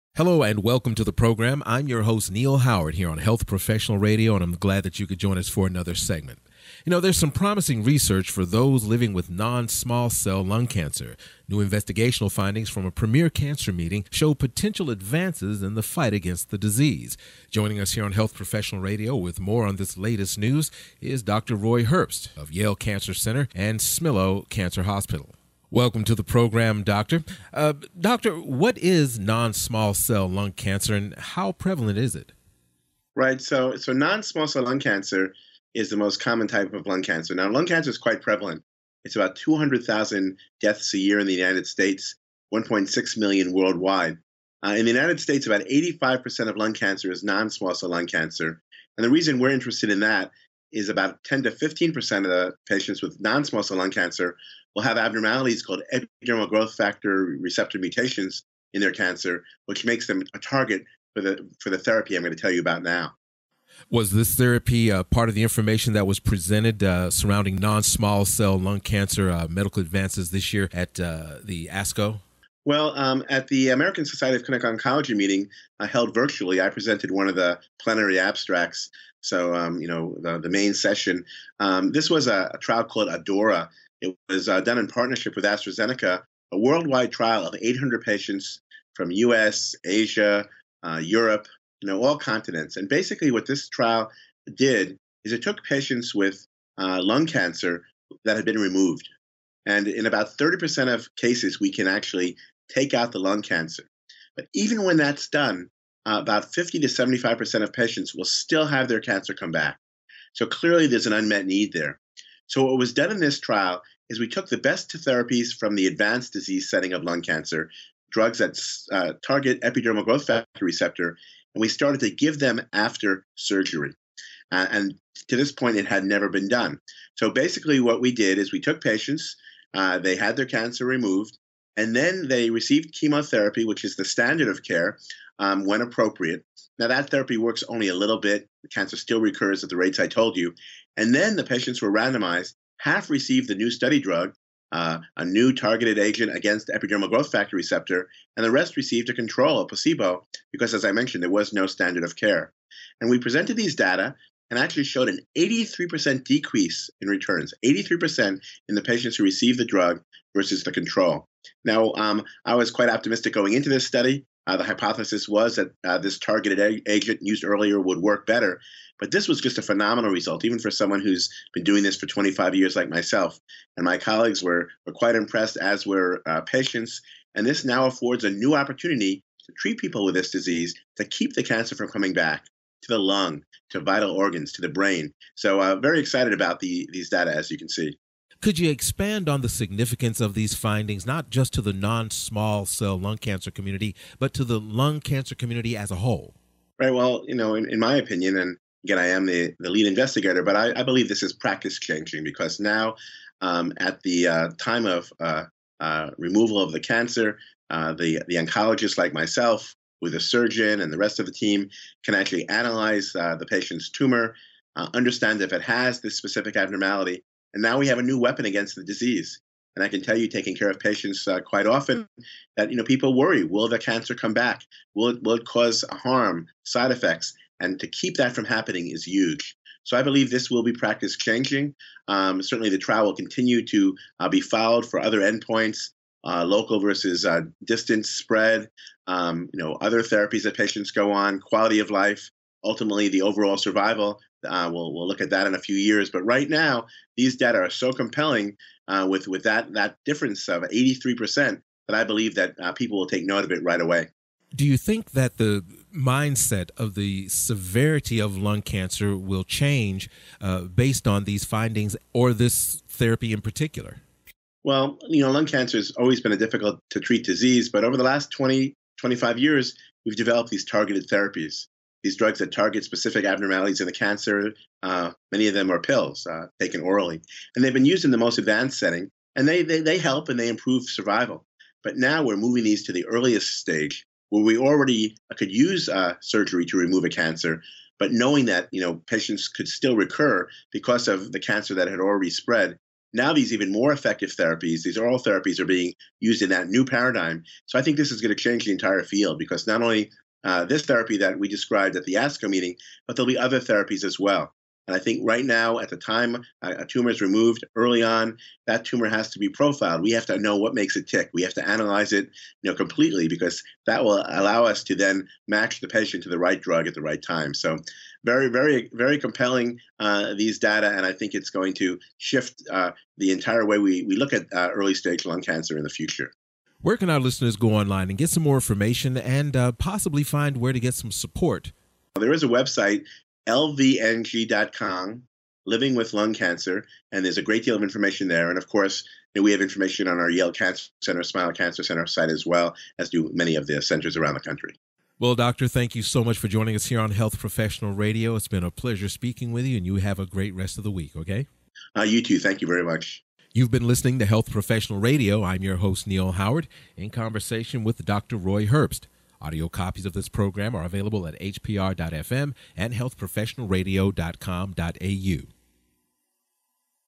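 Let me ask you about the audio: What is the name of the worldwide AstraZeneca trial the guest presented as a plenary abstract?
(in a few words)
ADAURA.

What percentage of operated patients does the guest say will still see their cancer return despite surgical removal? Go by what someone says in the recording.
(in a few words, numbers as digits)
50 to 75%.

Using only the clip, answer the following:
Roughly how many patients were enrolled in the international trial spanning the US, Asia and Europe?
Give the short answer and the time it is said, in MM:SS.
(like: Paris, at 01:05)
800, at 01:27.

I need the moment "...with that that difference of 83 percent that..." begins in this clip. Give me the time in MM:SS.
04:09.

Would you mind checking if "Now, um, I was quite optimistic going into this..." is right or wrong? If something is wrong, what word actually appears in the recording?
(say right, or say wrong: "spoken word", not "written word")
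right.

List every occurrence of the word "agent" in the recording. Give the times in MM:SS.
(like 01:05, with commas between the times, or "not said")
02:25, 02:46.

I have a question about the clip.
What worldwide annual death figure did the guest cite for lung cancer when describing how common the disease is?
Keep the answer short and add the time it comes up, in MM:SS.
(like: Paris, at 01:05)
1.6 million, at 00:42.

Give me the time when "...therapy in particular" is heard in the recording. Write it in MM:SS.
04:22.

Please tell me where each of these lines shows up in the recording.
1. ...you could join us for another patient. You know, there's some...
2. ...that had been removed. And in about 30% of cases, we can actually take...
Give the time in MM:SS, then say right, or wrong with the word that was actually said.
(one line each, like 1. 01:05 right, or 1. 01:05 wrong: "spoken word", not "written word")
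1. 00:04 wrong: "segment", not "patient"
2. 01:38 right.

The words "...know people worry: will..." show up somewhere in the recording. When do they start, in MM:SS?
03:42.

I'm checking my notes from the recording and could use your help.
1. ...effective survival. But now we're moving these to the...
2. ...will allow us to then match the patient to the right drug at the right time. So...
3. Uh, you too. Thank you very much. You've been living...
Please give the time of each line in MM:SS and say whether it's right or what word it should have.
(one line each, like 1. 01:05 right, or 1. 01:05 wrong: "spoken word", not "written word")
1. 04:40 wrong: "improve", not "effective"
2. 05:14 right
3. 05:51 wrong: "listening", not "living".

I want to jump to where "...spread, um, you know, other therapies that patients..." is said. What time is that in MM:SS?
03:58.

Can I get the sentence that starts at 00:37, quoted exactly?
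Now, lung cancer is quite prevalent.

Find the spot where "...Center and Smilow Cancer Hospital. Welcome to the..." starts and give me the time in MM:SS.
00:23.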